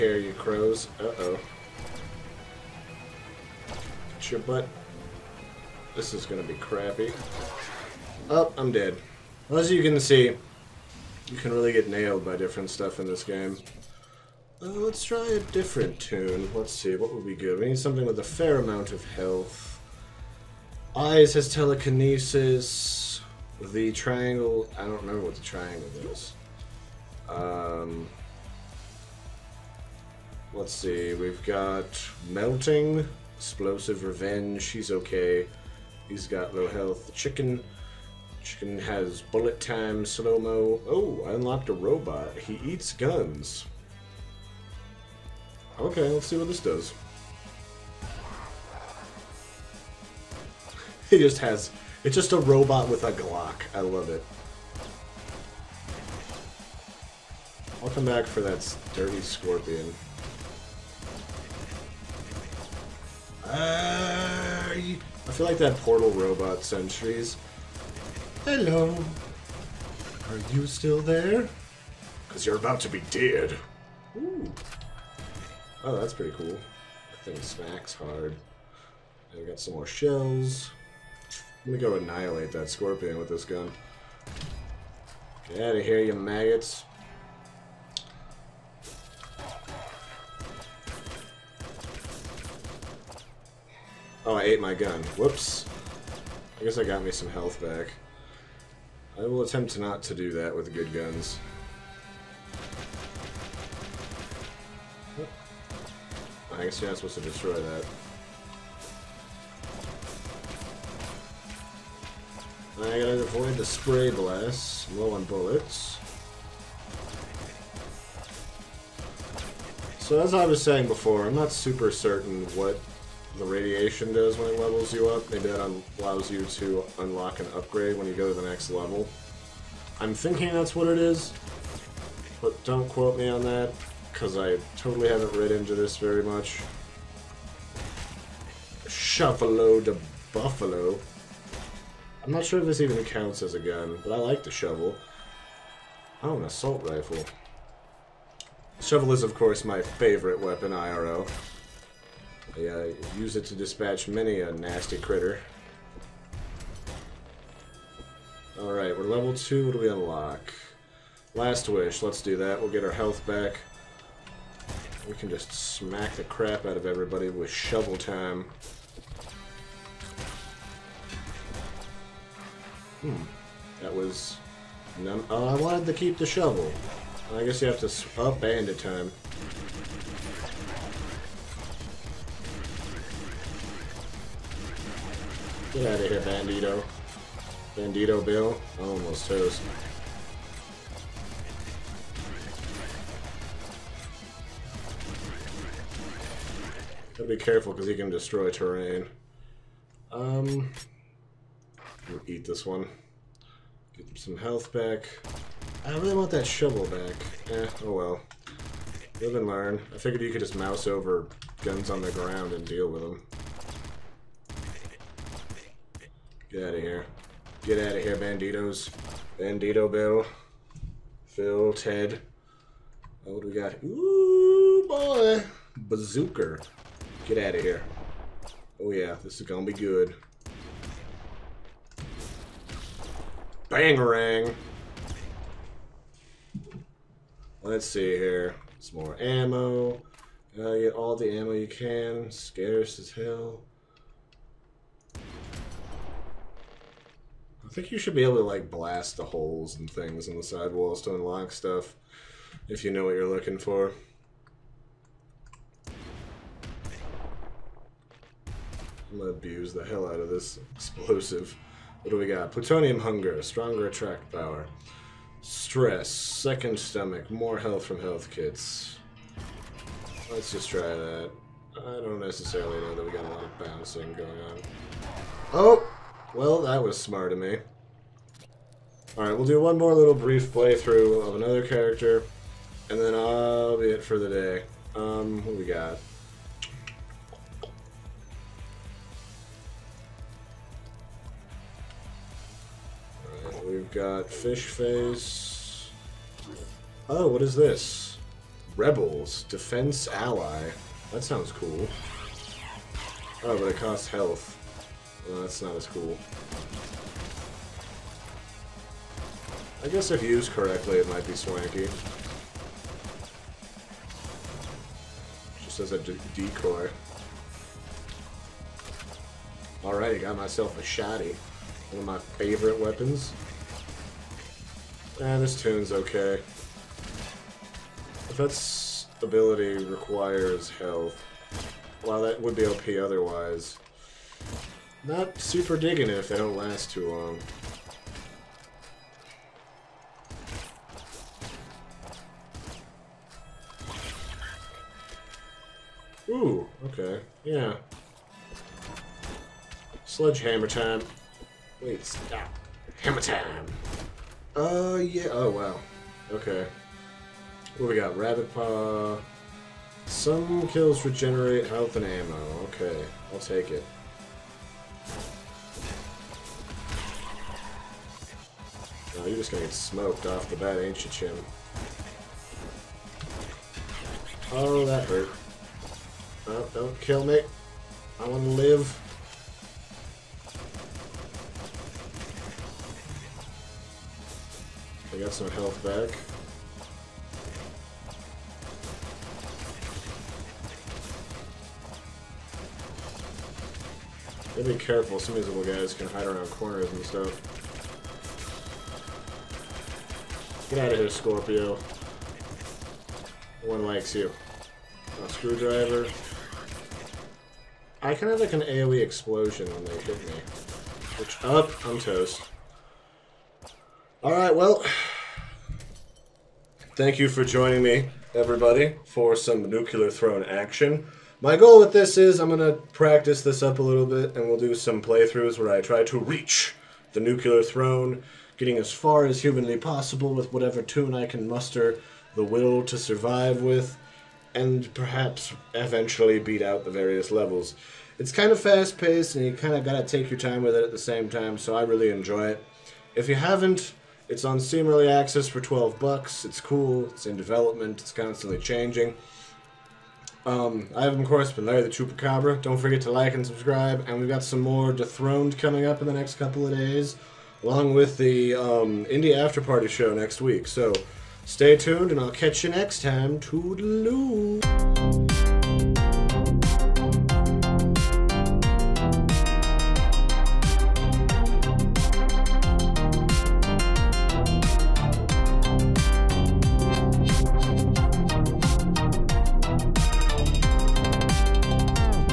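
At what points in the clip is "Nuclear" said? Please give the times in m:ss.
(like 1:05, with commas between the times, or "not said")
6:59, 7:07.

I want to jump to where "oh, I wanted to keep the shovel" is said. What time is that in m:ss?
2:55.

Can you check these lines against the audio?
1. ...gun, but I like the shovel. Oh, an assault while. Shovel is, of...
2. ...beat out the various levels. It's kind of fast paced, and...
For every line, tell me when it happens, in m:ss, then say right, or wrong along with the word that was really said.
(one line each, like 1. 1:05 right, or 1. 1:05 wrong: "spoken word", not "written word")
1. 2:23 wrong: "rifle", not "while"
2. 7:16 right.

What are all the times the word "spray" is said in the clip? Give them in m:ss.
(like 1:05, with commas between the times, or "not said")
1:53.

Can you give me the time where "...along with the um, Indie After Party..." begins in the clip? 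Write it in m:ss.
7:37.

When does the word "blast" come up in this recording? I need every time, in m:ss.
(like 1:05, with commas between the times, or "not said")
1:54, 4:08.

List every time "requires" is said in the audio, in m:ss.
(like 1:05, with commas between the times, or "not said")
5:29.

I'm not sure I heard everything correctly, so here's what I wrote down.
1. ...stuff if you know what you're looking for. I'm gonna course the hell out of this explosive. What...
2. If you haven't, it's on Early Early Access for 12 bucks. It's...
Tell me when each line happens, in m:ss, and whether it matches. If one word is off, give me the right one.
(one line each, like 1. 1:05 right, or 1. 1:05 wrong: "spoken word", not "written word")
1. 4:11 wrong: "abuse", not "course"
2. 7:23 wrong: "Steam", not "Early".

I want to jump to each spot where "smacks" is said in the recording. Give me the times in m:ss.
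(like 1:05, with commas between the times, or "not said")
1:17, 2:45.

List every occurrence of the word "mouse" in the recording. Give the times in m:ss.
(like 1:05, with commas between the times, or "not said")
3:30.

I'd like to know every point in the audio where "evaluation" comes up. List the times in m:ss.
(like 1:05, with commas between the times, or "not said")
not said.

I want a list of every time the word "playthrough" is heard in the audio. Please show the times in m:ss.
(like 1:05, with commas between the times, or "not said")
4:40, 7:05.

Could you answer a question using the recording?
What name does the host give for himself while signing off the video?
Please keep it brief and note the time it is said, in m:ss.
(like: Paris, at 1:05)
Larry the Chupacabra, at 7:31.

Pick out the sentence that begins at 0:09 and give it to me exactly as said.
As you can see, you can really get nailed by different stuff in this game.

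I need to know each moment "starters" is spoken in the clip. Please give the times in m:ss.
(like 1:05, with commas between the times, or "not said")
not said.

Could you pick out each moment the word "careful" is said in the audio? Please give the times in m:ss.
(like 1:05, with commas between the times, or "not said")
3:17, 6:34.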